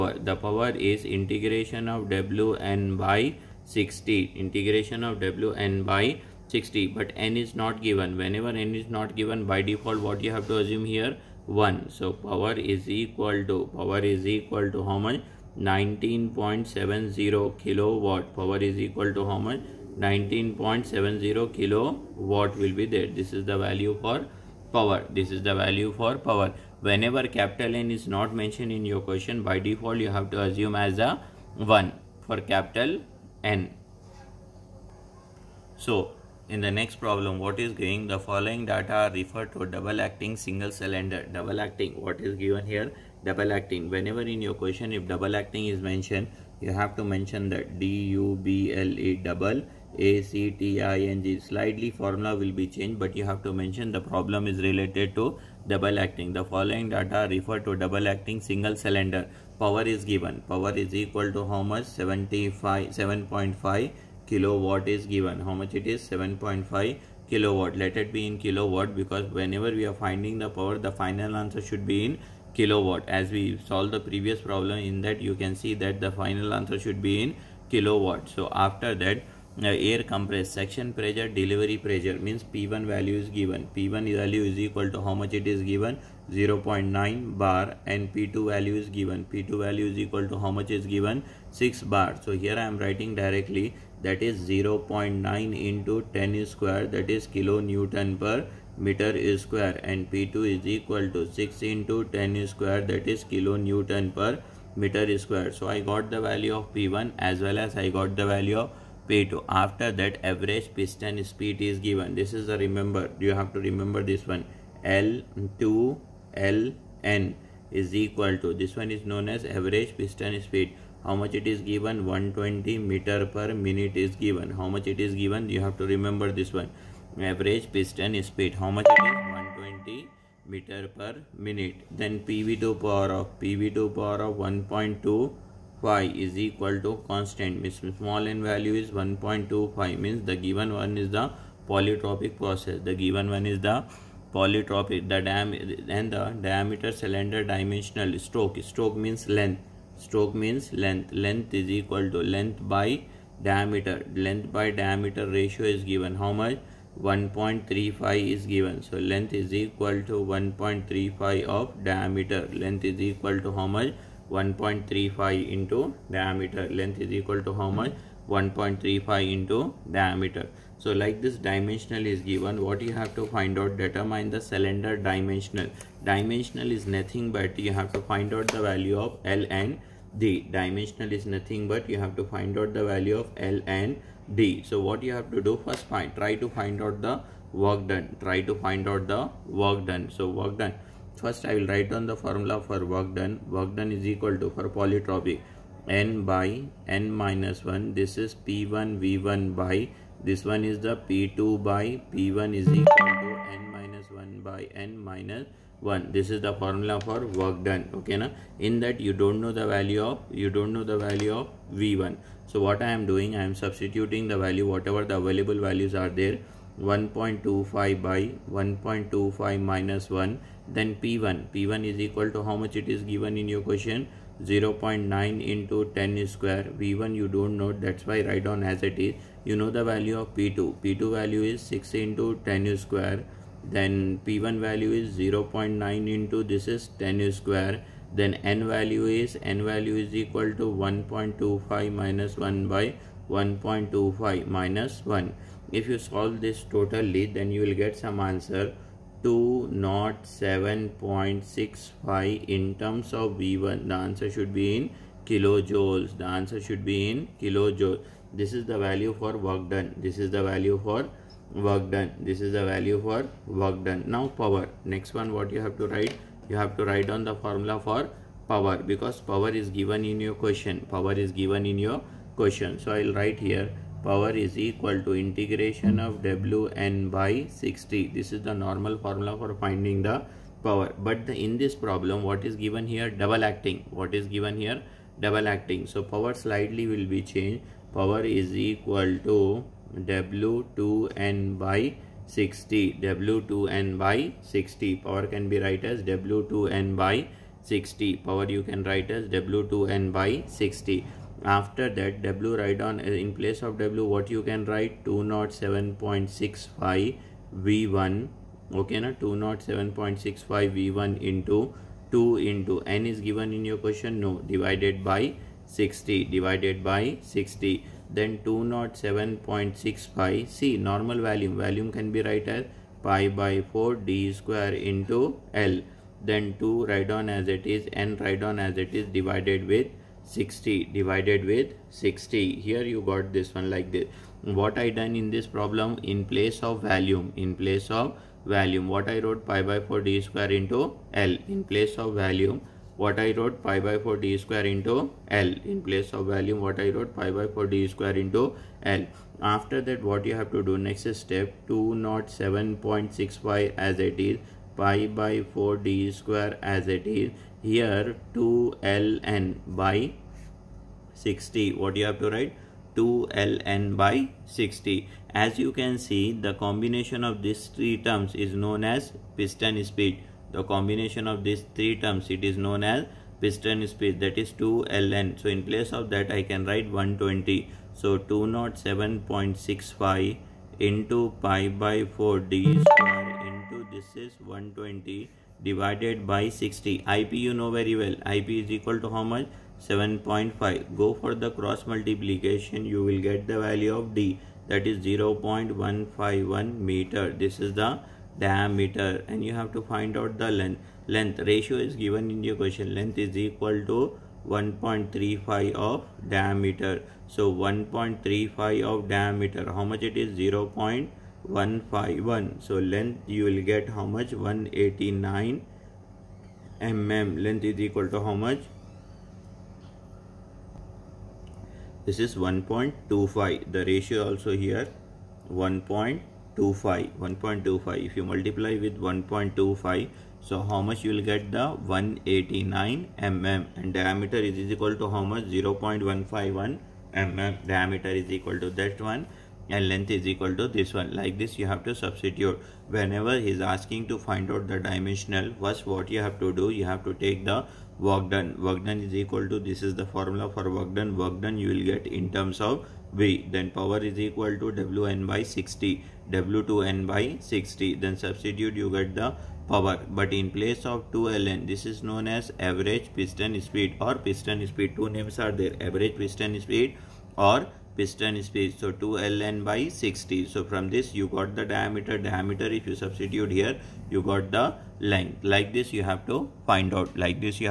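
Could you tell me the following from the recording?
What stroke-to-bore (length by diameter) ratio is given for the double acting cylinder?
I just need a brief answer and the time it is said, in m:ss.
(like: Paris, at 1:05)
1.35, at 2:37.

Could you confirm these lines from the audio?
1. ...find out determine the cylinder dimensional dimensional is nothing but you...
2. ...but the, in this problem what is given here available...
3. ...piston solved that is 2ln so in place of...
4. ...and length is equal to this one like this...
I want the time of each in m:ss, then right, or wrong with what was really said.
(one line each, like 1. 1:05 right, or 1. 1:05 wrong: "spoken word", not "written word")
1. 2:53 right
2. 4:41 wrong: "double", not "available"
3. 6:13 wrong: "speed", not "solved"
4. 7:19 right.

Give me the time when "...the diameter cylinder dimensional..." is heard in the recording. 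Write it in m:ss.
2:26.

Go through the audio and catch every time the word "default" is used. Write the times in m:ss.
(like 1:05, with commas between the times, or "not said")
0:09, 0:29.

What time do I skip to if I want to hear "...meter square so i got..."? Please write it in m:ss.
1:44.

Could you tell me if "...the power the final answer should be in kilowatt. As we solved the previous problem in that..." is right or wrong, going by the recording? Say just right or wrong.
right.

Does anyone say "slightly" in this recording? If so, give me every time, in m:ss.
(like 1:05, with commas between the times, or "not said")
0:51, 4:46.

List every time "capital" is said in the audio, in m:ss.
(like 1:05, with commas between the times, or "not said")
0:27, 0:32.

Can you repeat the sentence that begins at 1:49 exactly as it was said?
After that average piston speed is given.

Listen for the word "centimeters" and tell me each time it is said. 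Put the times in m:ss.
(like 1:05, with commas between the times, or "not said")
not said.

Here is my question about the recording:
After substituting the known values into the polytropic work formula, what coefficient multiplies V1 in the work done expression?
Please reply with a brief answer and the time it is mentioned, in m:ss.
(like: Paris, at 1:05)
207.65, at 4:09.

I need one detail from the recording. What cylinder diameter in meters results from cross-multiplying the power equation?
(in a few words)
0.151 m.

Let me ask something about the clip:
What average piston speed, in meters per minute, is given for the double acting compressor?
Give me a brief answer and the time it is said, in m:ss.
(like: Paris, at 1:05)
120 m/min, at 2:02.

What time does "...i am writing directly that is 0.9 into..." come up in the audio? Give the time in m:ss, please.
1:32.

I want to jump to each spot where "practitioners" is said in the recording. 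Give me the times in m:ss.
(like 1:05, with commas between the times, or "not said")
not said.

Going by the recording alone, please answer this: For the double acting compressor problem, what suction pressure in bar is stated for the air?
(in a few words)
0.9 bar.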